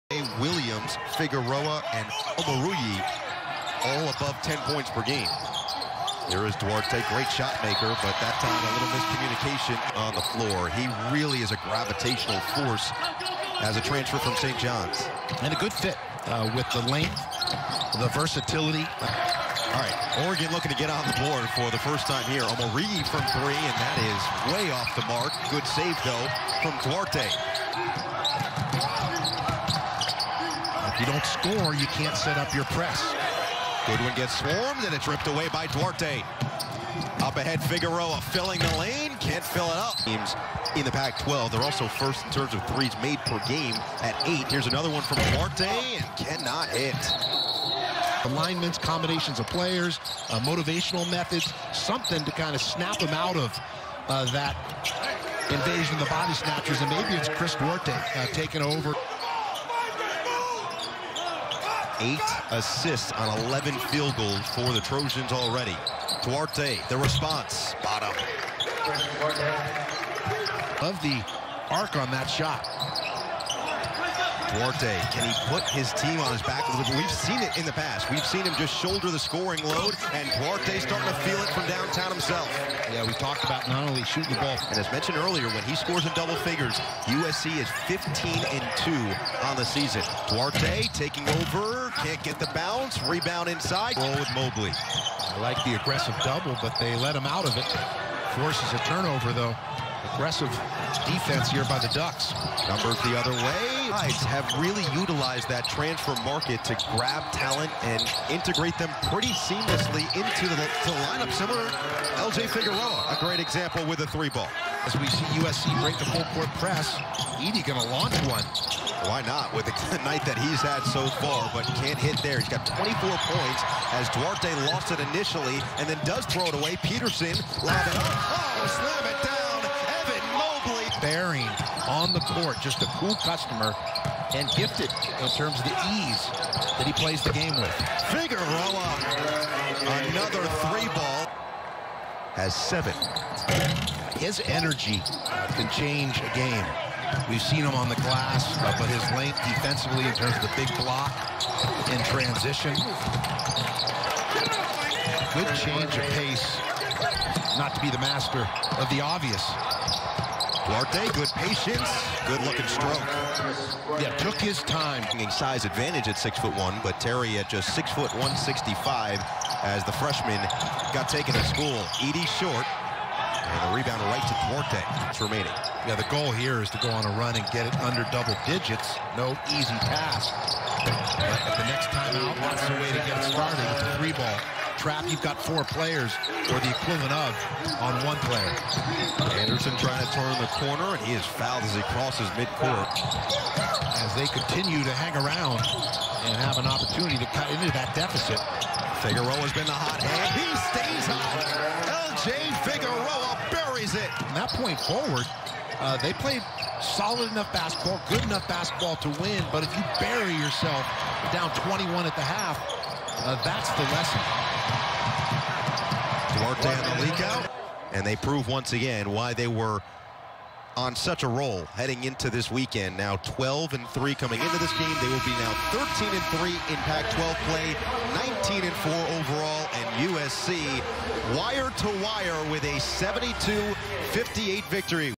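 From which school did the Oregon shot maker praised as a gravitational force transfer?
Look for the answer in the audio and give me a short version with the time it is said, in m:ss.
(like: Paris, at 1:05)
St. John's, at 0:14.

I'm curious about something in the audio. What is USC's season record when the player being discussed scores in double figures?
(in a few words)
15 and 2.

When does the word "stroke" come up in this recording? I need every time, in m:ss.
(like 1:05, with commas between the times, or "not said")
2:42.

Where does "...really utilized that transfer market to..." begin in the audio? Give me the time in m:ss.
1:44.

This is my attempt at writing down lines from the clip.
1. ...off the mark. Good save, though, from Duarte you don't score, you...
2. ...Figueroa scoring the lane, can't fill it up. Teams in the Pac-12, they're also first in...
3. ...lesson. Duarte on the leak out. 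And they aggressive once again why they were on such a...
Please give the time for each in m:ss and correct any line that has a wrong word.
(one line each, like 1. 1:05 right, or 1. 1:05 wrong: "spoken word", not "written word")
1. 0:24 right
2. 0:37 wrong: "filling", not "scoring"
3. 3:33 wrong: "prove", not "aggressive".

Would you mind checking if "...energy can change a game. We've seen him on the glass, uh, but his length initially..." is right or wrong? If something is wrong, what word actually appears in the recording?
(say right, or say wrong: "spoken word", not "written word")
wrong: "defensively", not "initially".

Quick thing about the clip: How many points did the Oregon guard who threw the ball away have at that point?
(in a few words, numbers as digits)
24.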